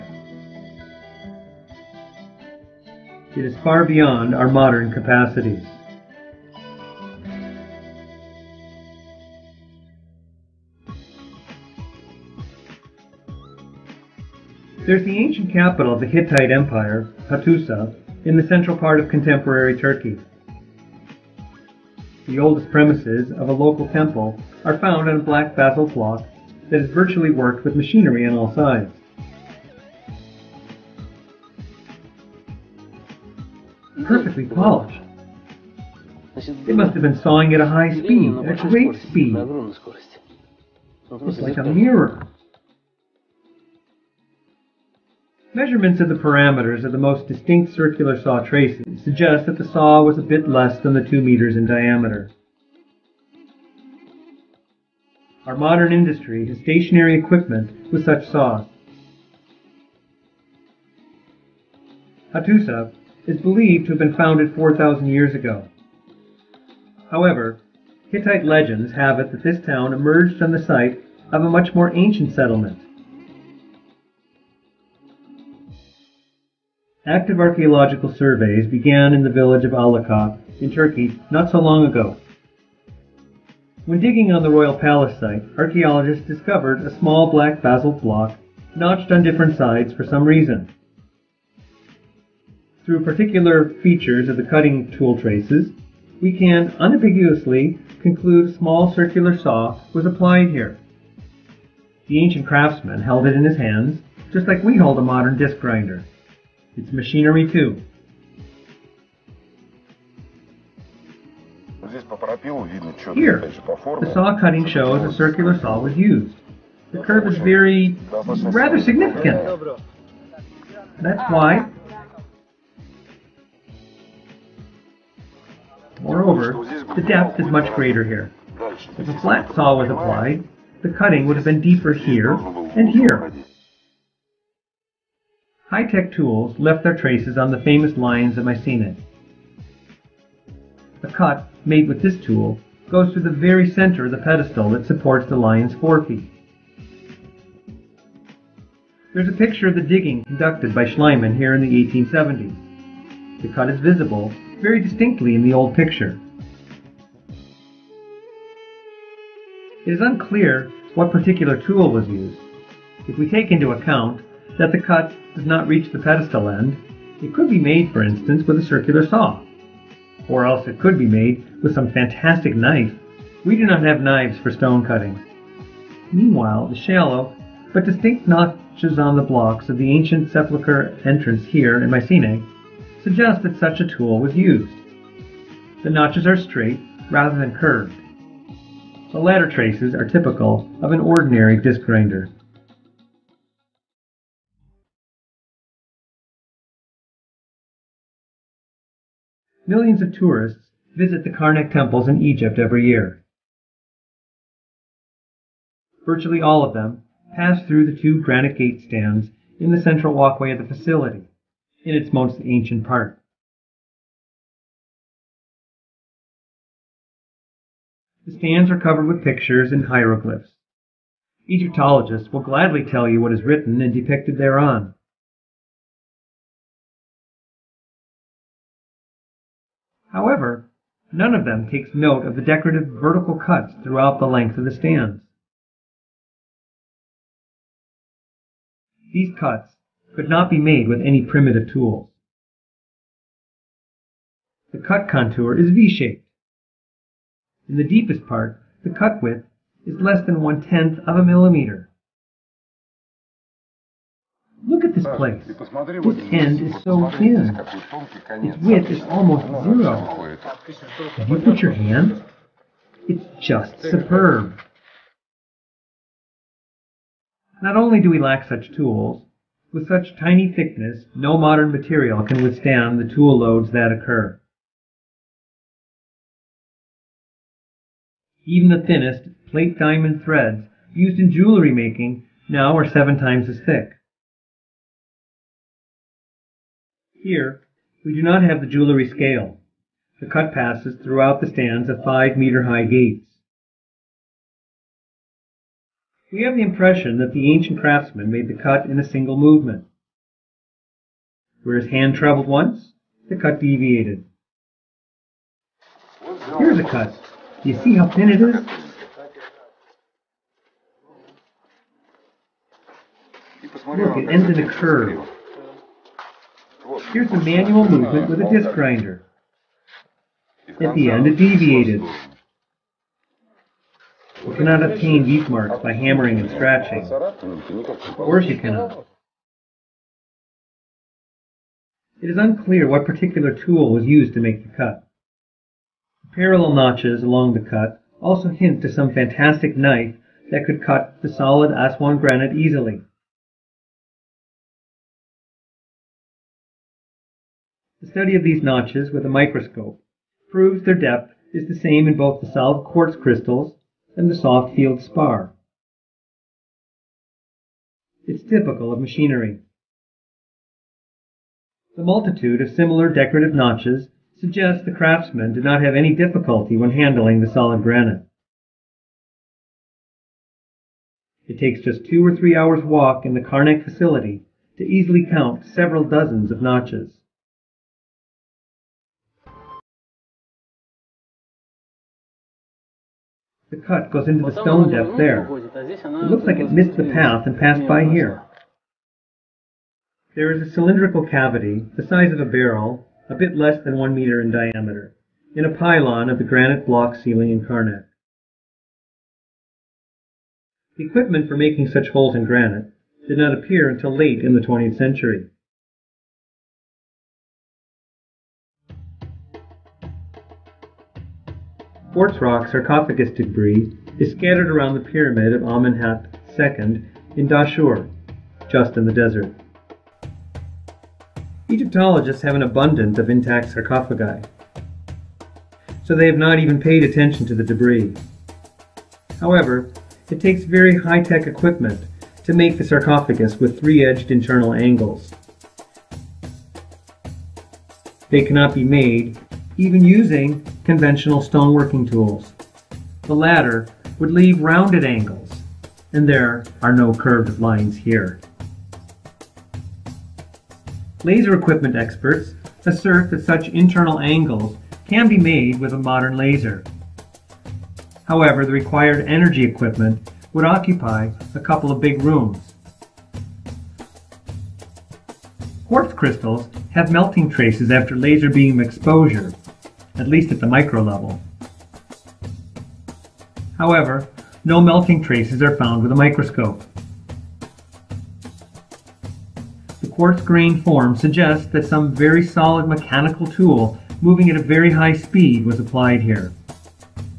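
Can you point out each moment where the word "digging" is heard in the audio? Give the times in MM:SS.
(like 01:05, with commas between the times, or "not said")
01:24, 02:29.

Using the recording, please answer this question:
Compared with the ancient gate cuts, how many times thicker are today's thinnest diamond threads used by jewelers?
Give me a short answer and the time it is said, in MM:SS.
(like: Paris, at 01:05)
7 times, at 04:42.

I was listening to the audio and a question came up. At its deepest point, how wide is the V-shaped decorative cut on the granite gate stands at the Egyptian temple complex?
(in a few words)
less than 0.1 mm.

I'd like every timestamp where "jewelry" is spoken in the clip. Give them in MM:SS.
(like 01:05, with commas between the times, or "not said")
04:41, 04:48.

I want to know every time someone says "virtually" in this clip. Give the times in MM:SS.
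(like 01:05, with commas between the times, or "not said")
00:26, 03:26.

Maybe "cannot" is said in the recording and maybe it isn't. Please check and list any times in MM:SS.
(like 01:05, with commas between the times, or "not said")
05:24, 05:28, 07:18.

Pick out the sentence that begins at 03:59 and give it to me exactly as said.
These cuts could not be made with any primitive tools.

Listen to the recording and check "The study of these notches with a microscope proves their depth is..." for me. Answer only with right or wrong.
right.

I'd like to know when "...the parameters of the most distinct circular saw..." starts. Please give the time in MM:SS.
00:46.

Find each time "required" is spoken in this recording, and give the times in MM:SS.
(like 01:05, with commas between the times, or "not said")
07:38.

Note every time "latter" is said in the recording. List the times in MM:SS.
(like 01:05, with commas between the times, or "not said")
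03:09, 07:23.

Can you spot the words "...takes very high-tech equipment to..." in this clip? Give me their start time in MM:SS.
07:10.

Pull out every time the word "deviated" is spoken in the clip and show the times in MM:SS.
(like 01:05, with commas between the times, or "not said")
05:03, 05:21.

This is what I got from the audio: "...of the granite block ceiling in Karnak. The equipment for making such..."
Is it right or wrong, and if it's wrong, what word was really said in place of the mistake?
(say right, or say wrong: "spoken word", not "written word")
right.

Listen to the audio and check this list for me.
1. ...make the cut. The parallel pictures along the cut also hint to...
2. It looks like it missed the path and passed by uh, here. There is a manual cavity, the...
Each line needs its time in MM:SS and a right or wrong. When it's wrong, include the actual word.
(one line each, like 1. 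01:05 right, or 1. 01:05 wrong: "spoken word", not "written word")
1. 05:34 wrong: "notches", not "pictures"
2. 06:25 wrong: "cylindrical", not "manual".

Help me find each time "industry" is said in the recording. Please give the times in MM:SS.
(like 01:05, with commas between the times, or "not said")
00:55.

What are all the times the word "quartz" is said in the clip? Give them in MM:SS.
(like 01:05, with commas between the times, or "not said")
05:52, 06:52, 07:45, 08:00.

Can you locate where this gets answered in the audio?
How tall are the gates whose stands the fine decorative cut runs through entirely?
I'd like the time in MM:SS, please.
04:52.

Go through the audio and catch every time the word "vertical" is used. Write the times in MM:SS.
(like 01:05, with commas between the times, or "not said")
03:52.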